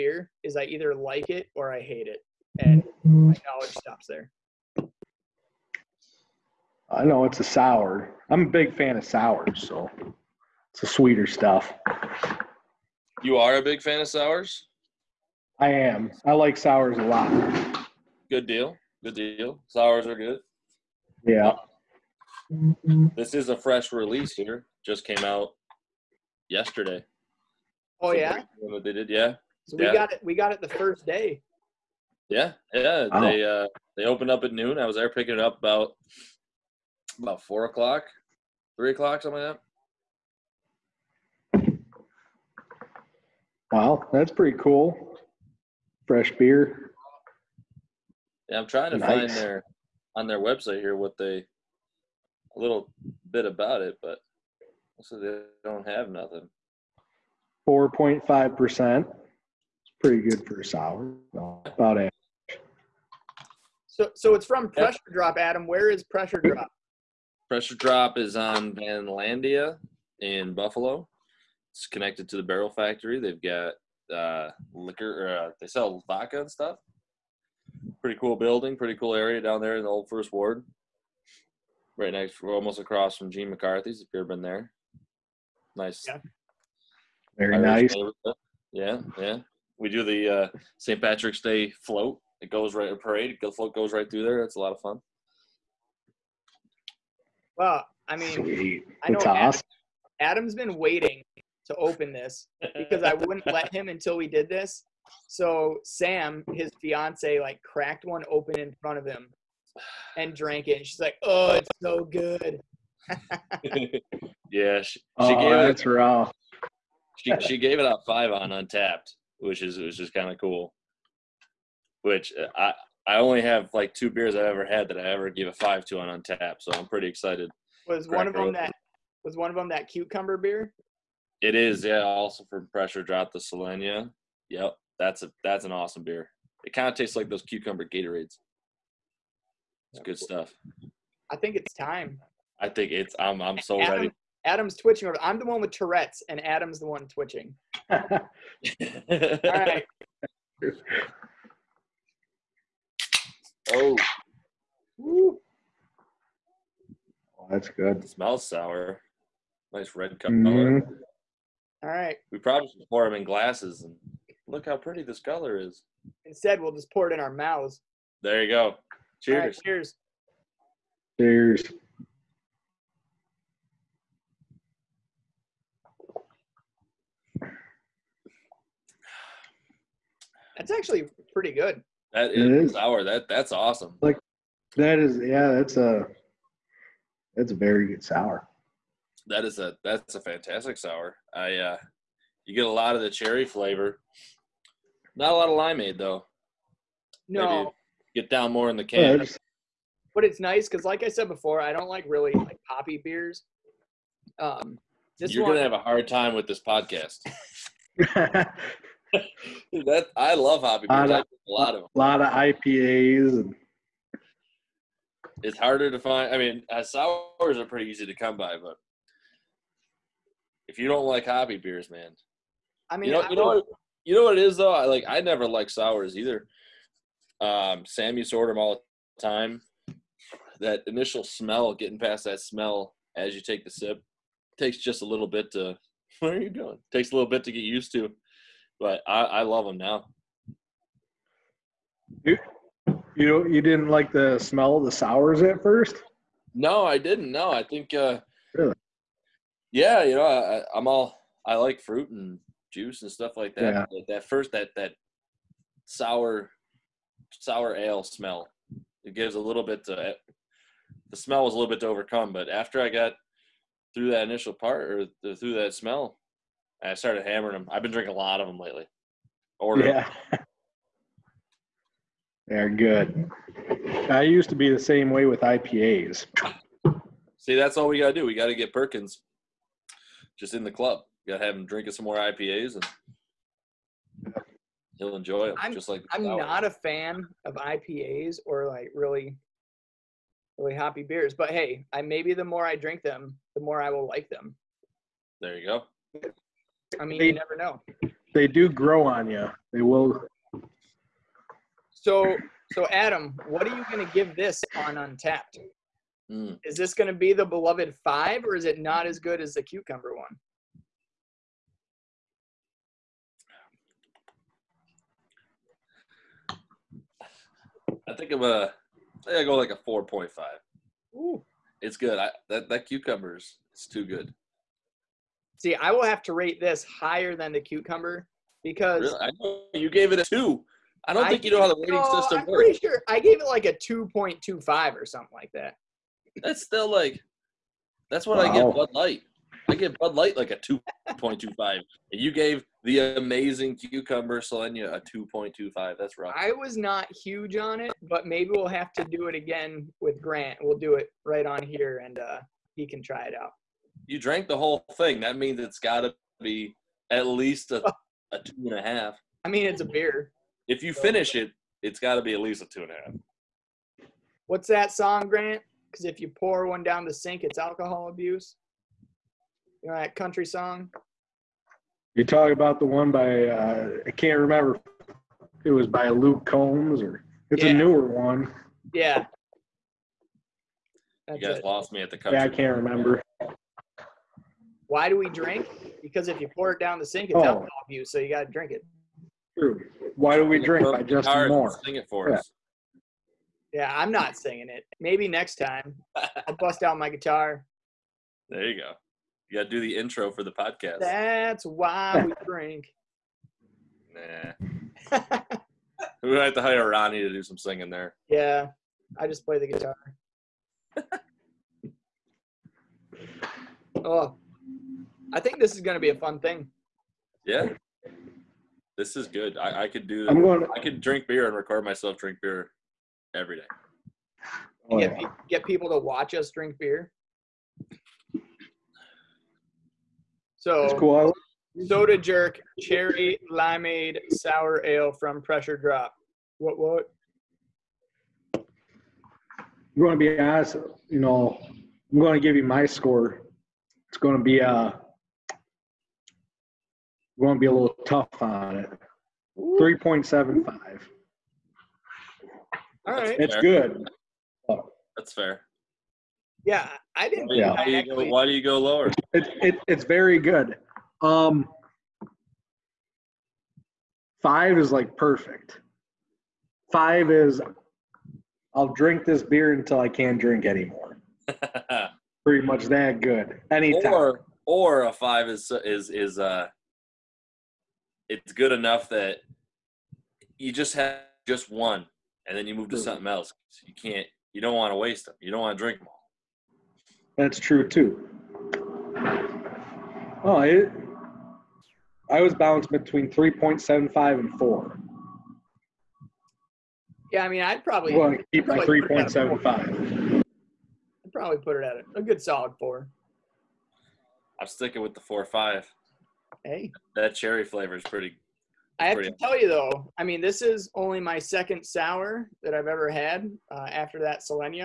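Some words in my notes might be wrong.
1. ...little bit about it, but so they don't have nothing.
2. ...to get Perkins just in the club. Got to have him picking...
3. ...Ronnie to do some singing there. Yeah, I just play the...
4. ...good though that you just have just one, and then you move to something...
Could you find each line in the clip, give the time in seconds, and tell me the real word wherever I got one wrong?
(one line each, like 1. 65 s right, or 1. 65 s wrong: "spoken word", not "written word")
1. 52 s right
2. 278 s wrong: "drinking", not "picking"
3. 406 s right
4. 478 s wrong: "enough", not "though".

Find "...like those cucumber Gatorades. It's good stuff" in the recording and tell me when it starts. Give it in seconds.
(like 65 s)
137 s.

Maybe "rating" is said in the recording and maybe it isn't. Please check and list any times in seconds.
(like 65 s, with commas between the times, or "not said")
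331 s.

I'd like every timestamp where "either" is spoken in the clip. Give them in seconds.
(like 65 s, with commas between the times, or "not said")
0 s, 226 s.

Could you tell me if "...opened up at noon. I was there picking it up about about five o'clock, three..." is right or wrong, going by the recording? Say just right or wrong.
wrong.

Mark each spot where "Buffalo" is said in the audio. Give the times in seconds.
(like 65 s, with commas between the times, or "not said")
70 s.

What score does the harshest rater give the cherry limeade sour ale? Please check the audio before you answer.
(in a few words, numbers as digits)
3.75.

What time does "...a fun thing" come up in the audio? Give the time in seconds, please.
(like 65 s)
416 s.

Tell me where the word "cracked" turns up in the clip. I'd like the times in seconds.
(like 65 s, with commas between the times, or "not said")
107 s.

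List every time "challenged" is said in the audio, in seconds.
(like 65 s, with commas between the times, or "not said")
not said.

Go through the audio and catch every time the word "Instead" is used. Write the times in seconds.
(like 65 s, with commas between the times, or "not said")
166 s.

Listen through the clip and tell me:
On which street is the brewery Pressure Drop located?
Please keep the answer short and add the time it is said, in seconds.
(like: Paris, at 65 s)
Vandalia, at 68 s.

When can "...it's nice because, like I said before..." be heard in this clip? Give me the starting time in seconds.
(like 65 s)
200 s.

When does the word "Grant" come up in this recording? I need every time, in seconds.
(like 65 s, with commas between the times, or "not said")
350 s, 365 s.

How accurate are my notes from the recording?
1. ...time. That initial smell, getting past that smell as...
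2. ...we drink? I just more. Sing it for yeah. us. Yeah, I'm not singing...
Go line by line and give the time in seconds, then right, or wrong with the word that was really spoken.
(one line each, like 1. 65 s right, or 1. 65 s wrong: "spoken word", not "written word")
1. 229 s right
2. 390 s right.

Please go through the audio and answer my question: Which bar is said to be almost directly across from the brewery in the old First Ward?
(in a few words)
Gene McCarthy's.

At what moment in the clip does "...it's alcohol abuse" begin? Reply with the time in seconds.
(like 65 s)
367 s.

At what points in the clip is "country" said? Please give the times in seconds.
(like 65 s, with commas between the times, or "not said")
370 s, 382 s.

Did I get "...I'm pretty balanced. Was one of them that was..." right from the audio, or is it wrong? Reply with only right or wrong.
wrong.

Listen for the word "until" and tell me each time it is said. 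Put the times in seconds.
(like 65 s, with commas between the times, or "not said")
103 s, 469 s.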